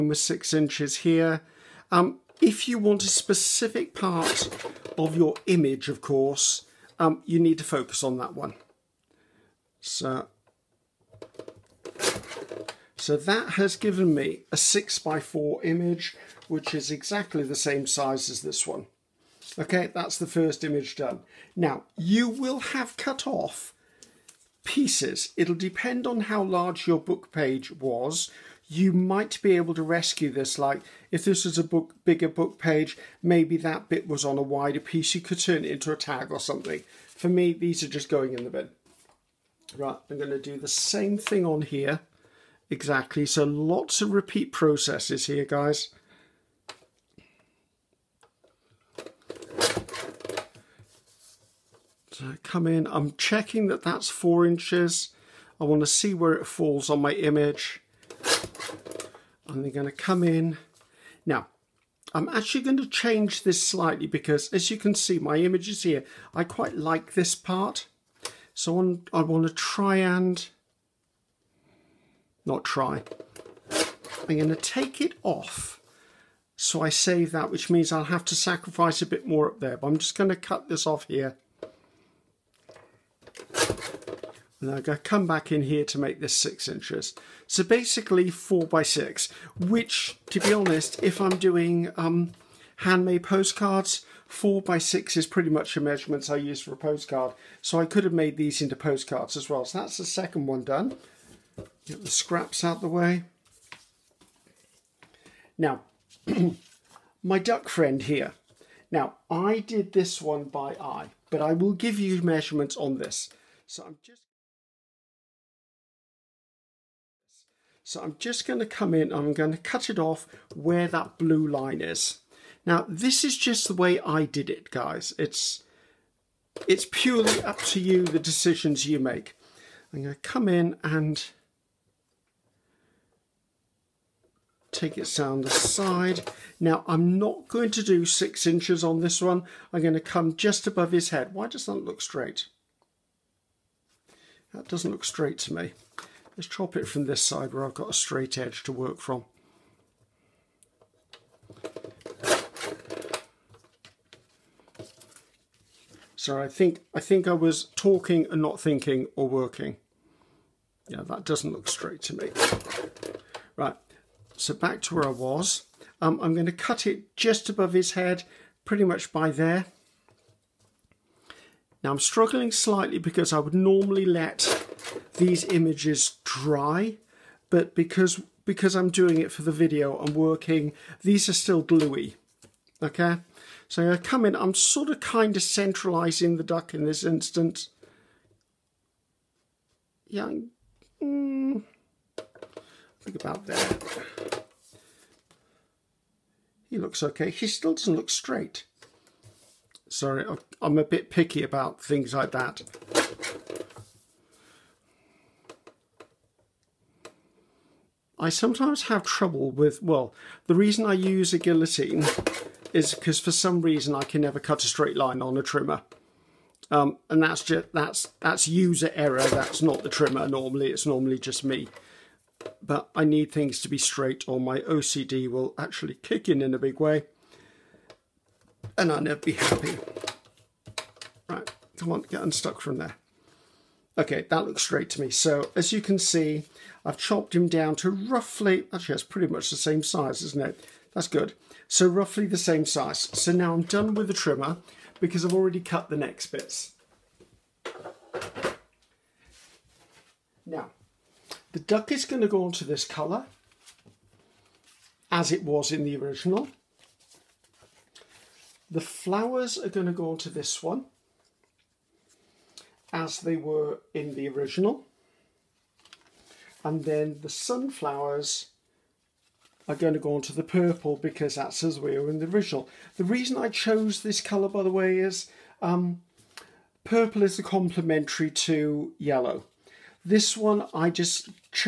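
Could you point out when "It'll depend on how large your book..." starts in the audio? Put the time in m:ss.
0:25.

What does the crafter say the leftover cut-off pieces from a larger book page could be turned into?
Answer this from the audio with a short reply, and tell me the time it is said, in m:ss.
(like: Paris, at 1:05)
A tag, at 0:35.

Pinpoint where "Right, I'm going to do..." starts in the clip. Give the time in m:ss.
0:39.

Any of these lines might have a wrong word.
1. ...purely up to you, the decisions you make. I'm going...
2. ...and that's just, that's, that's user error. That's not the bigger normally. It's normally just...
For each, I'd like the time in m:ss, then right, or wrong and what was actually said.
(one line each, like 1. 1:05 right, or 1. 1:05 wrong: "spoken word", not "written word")
1. 2:06 right
2. 3:37 wrong: "trimmer", not "bigger".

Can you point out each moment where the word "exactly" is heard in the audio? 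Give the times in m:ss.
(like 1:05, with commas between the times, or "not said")
0:16, 0:42.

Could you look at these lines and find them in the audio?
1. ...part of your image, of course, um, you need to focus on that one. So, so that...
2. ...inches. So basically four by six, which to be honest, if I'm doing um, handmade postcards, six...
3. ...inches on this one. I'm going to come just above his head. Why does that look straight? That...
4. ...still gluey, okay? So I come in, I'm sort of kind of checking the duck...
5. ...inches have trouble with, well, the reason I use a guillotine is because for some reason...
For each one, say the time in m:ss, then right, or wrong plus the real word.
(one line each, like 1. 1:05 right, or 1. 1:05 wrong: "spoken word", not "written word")
1. 0:03 right
2. 1:26 wrong: "four", not "six"
3. 2:18 right
4. 3:01 wrong: "centralizing", not "checking"
5. 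3:28 wrong: "sometimes", not "inches".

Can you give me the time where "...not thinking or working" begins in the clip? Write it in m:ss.
2:38.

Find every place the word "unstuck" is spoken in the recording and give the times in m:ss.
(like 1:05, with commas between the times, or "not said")
3:52.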